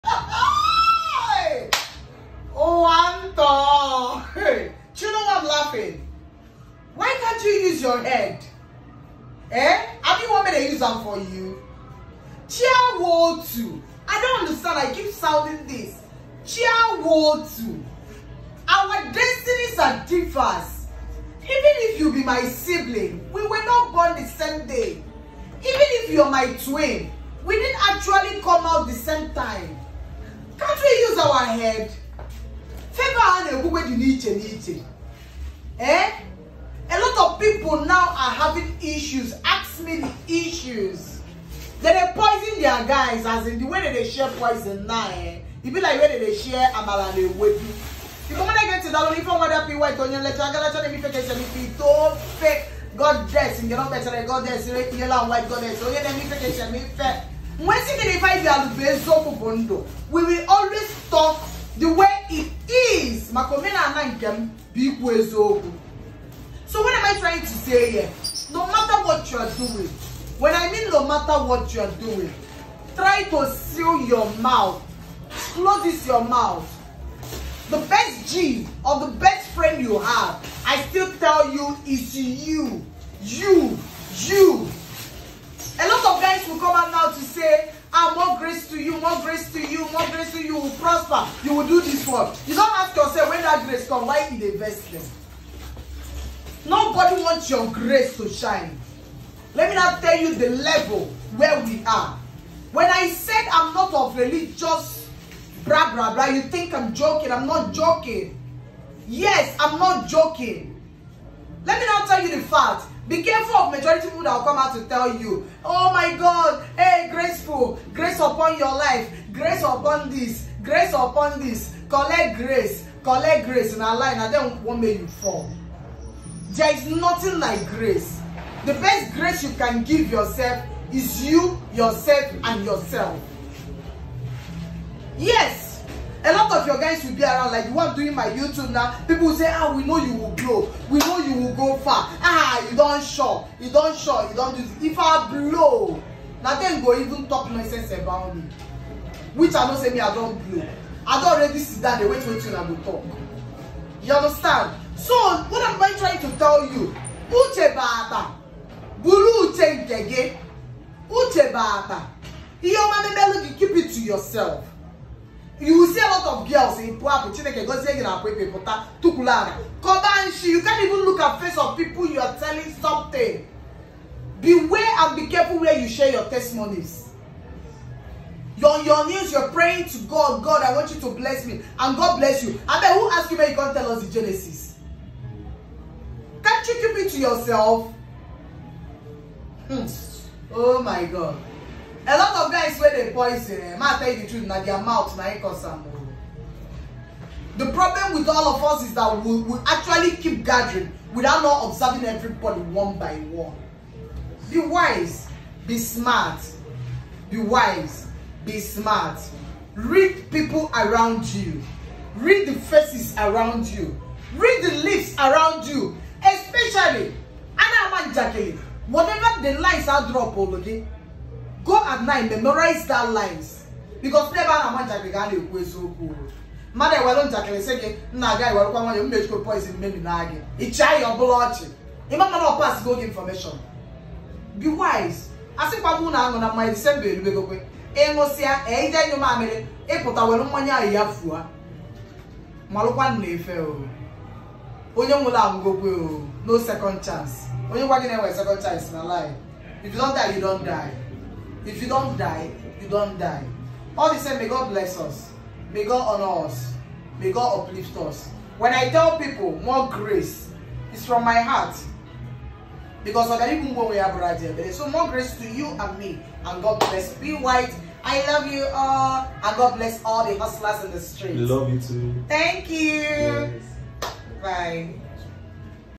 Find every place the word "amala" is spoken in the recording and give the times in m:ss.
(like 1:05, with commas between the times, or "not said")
0:46.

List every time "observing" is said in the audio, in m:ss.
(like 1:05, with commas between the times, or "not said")
3:21.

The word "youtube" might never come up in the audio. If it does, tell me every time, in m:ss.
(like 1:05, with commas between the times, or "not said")
2:18.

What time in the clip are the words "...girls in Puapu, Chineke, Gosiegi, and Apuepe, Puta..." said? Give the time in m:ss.
2:46.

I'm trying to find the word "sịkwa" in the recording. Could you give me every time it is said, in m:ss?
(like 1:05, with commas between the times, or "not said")
3:55.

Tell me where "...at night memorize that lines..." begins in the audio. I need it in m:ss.
3:41.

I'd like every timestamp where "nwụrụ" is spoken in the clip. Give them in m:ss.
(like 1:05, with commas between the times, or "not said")
4:05.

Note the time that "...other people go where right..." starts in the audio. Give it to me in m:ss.
4:23.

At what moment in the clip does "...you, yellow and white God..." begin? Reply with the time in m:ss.
0:54.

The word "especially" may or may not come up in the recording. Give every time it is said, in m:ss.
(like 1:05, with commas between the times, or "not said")
3:36.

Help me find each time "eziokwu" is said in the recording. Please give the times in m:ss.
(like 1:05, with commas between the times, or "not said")
1:05, 3:45.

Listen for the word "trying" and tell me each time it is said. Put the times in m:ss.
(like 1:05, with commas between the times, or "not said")
1:07, 2:35.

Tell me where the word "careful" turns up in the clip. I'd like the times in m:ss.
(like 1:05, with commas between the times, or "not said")
1:53, 2:55.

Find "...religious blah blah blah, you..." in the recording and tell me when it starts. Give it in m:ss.
1:44.